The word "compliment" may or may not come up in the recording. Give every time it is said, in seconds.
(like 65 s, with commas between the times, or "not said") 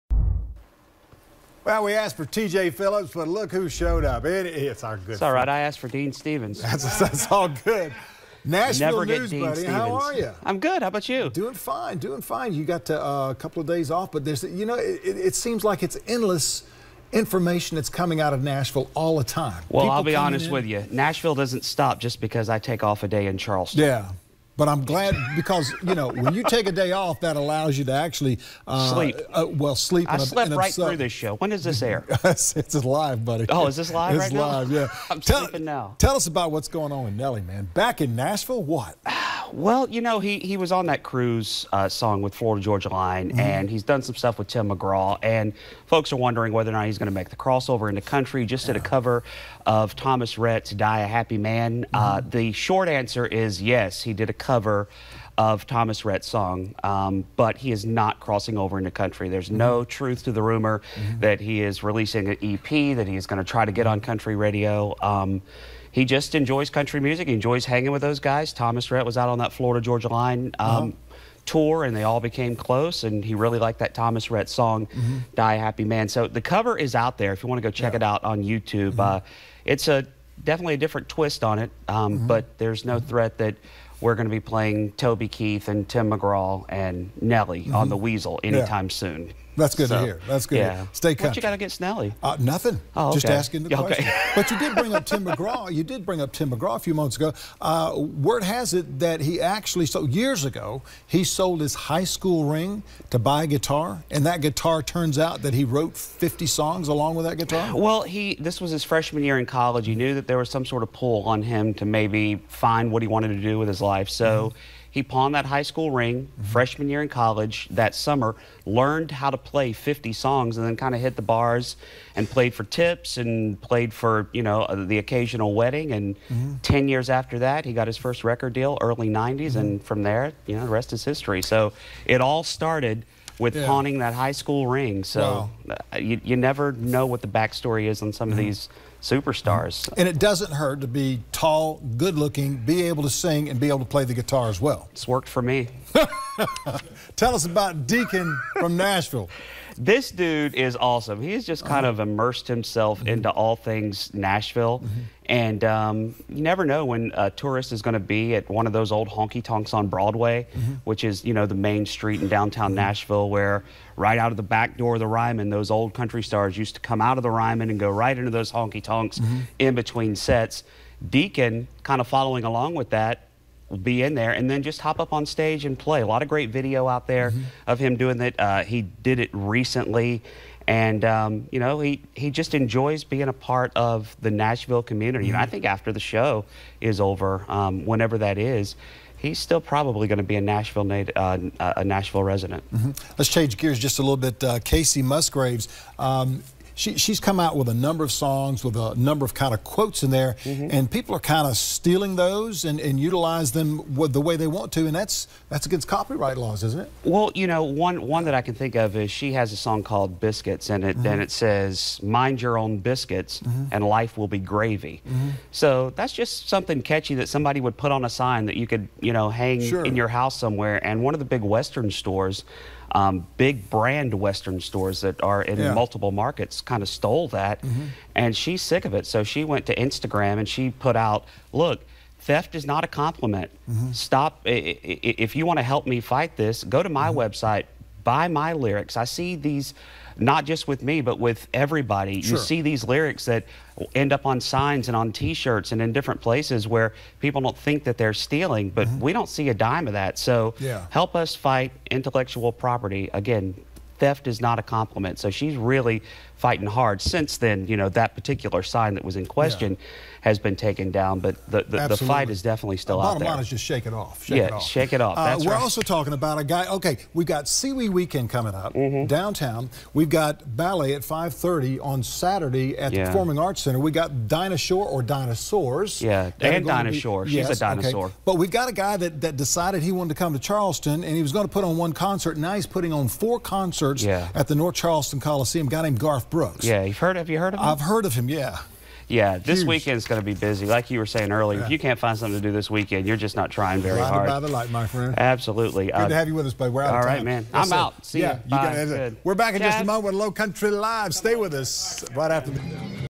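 232 s, 254 s.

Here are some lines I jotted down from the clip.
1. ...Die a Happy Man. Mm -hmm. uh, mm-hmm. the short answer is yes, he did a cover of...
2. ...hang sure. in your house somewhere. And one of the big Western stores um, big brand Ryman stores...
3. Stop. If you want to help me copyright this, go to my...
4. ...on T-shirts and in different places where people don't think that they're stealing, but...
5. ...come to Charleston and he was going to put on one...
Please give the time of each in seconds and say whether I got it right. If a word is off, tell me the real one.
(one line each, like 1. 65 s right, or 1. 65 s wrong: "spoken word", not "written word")
1. 50 s right
2. 219 s wrong: "Western", not "Ryman"
3. 233 s wrong: "fight", not "copyright"
4. 244 s right
5. 280 s right.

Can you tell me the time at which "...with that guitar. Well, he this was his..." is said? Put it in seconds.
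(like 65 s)
107 s.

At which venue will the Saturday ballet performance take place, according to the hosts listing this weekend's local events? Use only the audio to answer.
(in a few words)
Performing Arts Center.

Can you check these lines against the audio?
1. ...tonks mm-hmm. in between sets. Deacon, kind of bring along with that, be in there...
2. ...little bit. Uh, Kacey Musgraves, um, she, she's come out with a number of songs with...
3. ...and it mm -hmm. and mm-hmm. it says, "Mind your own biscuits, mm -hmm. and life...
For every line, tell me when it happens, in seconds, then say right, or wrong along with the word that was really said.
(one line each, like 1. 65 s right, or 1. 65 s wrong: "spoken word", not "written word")
1. 168 s wrong: "following", not "bring"
2. 194 s right
3. 210 s right.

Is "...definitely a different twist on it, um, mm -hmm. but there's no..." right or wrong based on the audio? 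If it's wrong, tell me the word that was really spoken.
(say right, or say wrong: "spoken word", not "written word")
right.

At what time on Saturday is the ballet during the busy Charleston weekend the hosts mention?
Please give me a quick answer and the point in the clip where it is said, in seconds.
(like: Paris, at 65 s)
5:30, at 271 s.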